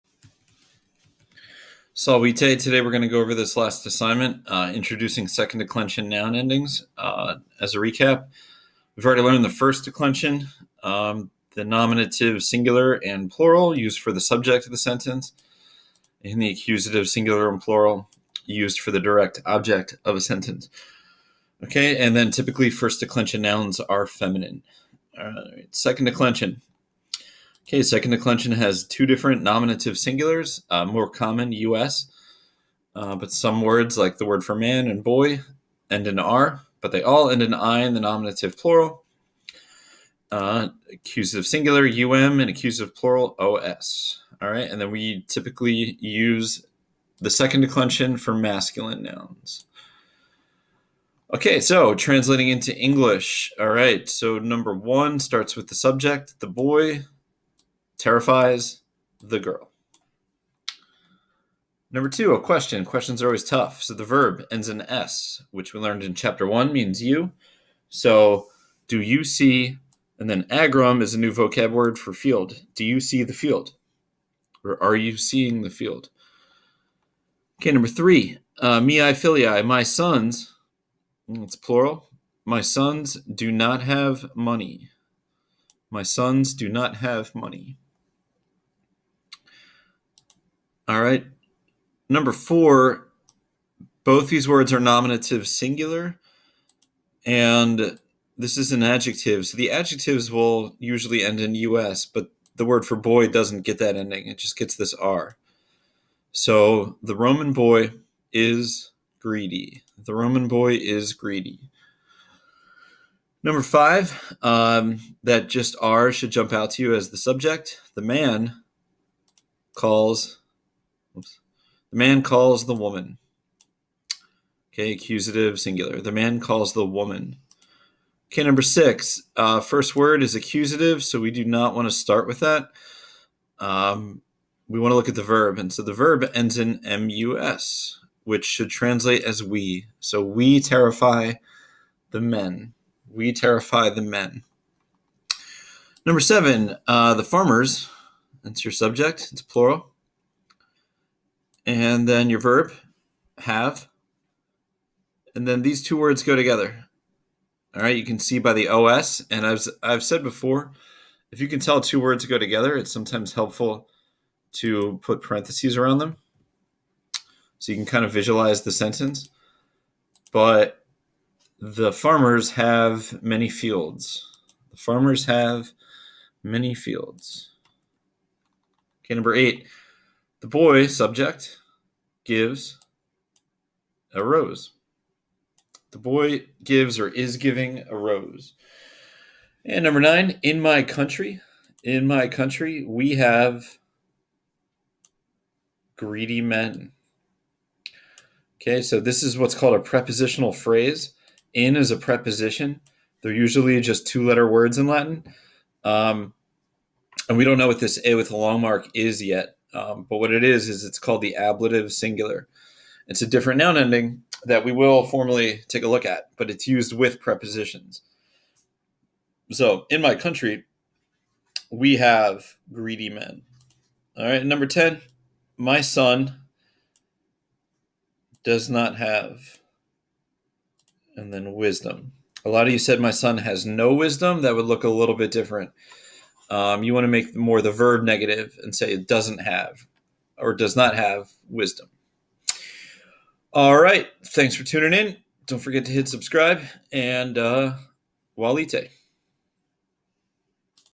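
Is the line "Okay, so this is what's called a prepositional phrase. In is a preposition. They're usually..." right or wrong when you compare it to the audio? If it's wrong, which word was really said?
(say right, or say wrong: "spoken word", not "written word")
right.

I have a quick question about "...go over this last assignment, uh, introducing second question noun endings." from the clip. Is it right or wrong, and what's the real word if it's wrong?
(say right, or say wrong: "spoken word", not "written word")
wrong: "declension", not "question".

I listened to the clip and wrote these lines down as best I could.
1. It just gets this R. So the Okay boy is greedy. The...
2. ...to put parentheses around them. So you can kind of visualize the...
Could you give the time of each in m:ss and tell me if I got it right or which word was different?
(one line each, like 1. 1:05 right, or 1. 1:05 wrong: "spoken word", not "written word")
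1. 1:44 wrong: "Roman", not "Okay"
2. 2:44 right.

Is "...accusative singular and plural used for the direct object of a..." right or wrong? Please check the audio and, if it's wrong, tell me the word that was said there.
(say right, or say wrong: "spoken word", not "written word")
right.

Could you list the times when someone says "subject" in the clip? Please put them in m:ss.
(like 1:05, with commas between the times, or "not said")
0:14, 0:55, 1:57, 2:28, 3:00.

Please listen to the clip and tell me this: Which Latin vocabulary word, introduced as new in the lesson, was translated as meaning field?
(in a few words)
agrum.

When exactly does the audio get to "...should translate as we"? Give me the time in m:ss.
2:18.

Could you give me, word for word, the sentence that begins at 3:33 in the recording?
It's a different noun ending that we will formally take a look at, but it's used with prepositions.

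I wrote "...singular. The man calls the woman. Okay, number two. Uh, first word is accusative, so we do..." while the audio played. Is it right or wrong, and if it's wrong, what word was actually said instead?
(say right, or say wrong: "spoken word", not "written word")
wrong: "six", not "two".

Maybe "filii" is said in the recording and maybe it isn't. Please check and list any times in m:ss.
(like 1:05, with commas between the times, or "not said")
1:19.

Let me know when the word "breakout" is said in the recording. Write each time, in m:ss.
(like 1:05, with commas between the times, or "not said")
not said.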